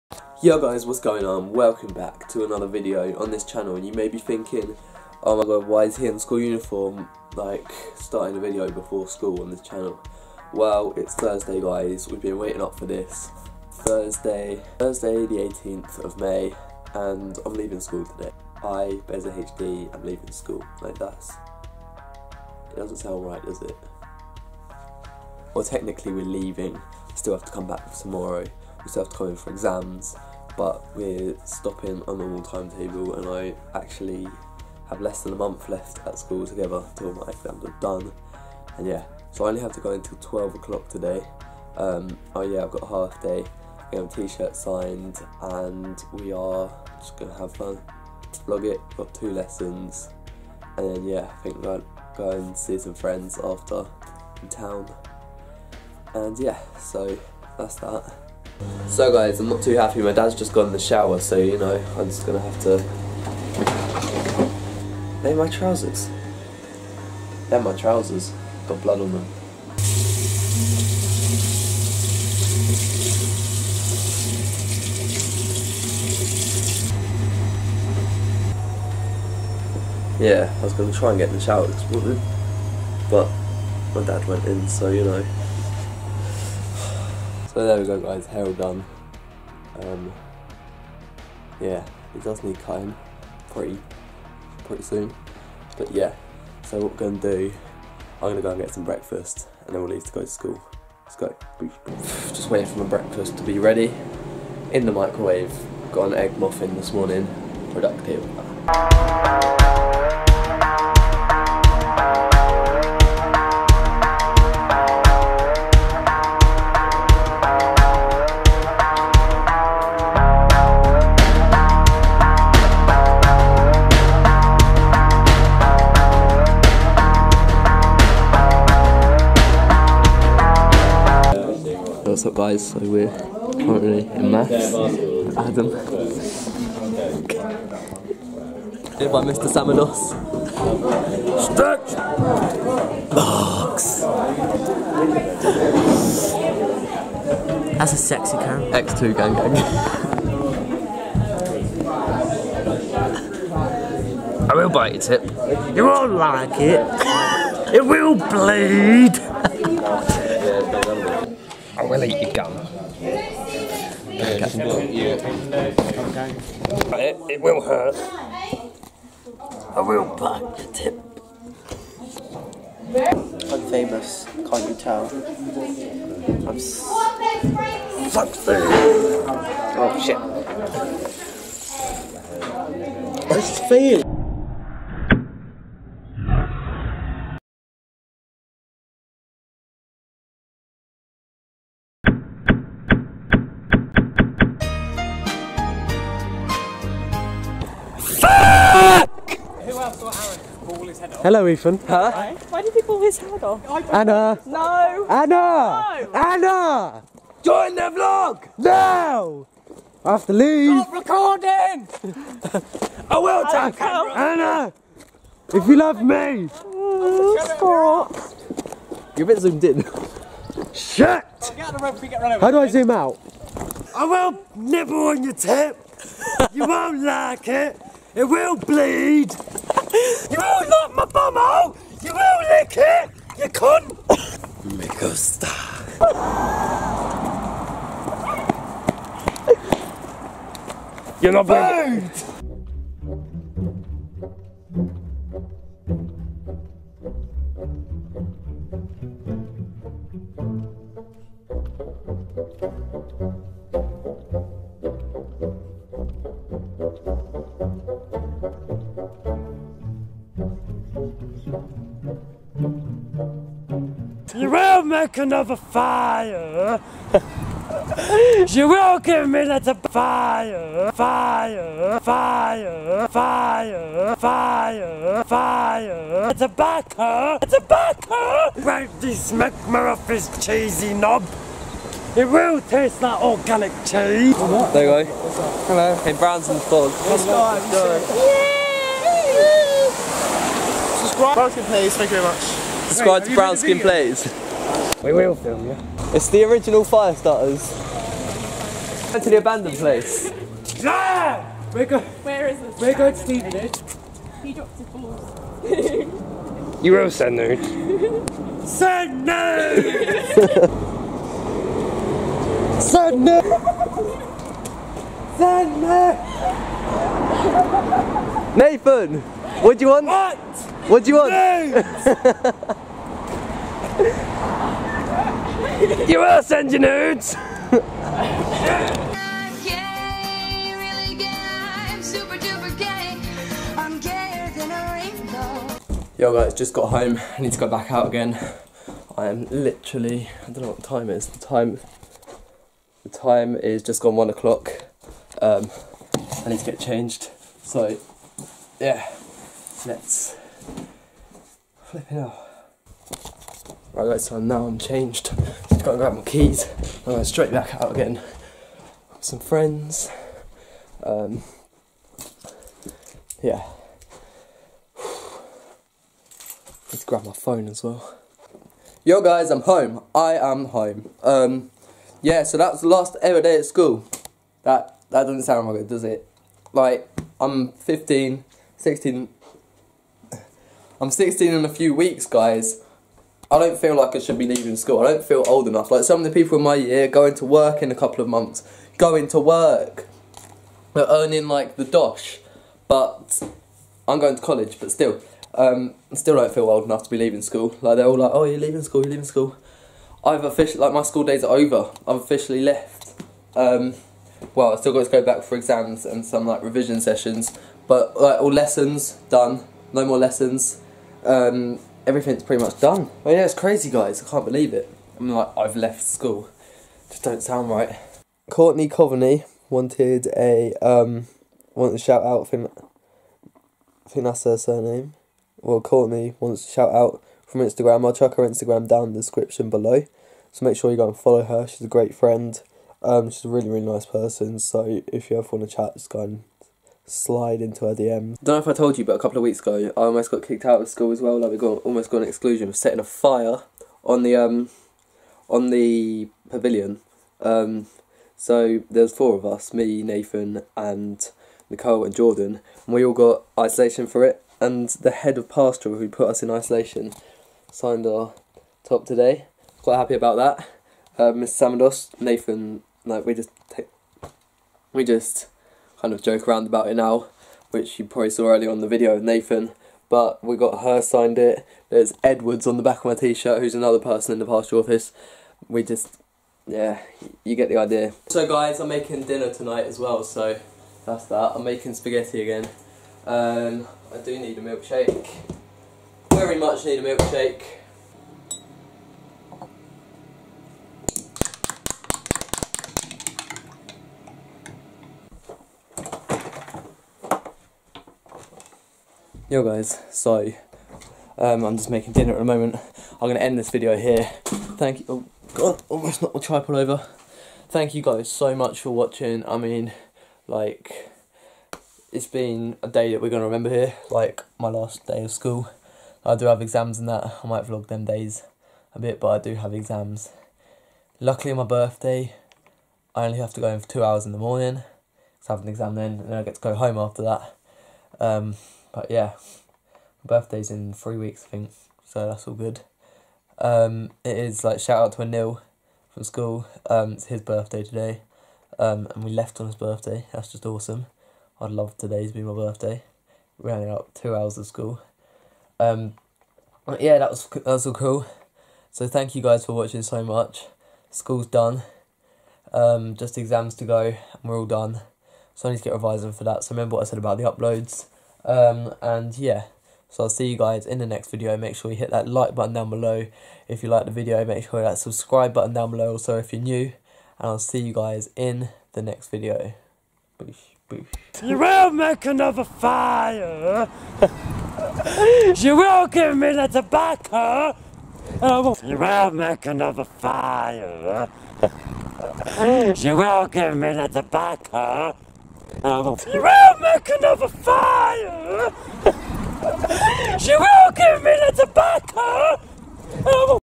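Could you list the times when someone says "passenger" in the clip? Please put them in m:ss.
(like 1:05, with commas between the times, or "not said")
not said.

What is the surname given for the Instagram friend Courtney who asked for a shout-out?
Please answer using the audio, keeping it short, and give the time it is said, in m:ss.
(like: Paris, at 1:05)
Coveney, at 6:58.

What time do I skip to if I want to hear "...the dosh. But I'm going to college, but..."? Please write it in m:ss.
6:31.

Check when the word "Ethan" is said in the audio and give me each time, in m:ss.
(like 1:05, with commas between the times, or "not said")
3:21.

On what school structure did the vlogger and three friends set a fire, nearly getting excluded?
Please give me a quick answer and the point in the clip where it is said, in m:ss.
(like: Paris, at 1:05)
the pavilion, at 7:26.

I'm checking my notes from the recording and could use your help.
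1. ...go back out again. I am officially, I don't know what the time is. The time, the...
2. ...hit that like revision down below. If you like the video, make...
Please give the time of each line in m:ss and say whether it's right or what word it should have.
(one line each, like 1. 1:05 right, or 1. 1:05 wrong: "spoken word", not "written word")
1. 5:37 wrong: "literally", not "officially"
2. 9:21 wrong: "button", not "revision".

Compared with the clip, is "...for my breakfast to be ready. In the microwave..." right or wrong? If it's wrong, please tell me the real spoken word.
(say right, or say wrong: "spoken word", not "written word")
right.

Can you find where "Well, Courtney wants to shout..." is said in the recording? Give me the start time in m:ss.
7:05.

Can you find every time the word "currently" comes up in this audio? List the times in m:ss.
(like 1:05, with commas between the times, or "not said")
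2:13.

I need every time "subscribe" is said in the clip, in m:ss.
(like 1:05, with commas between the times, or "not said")
4:52, 9:24.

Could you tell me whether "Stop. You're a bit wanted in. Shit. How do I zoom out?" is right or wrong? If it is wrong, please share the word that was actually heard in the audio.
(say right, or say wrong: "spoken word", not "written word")
wrong: "zoomed", not "wanted".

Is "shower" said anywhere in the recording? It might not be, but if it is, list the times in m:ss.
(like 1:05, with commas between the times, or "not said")
1:00, 1:21.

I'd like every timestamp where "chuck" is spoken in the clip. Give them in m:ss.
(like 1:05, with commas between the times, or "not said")
7:08.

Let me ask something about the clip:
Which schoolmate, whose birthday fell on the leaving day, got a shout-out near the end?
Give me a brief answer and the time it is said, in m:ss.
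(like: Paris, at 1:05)
Anil, at 8:55.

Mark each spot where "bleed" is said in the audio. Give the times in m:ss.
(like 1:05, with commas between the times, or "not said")
2:38, 3:48.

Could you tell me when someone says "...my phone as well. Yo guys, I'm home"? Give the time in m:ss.
6:07.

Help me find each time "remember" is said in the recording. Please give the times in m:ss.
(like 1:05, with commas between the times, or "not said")
8:33, 9:16.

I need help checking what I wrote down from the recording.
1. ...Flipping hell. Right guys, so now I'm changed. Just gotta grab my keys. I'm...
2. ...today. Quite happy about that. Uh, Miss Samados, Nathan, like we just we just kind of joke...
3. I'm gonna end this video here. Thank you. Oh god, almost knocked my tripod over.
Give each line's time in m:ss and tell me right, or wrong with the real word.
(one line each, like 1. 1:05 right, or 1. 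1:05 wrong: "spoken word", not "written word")
1. 5:51 right
2. 7:39 right
3. 8:23 right.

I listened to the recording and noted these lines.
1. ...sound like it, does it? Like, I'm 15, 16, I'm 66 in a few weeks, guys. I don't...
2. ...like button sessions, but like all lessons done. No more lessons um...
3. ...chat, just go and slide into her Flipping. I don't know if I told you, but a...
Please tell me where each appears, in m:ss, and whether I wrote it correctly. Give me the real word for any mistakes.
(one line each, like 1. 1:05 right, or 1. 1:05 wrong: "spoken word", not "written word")
1. 6:15 wrong: "16", not "66"
2. 6:46 wrong: "revision", not "button"
3. 7:15 wrong: "DMs", not "Flipping".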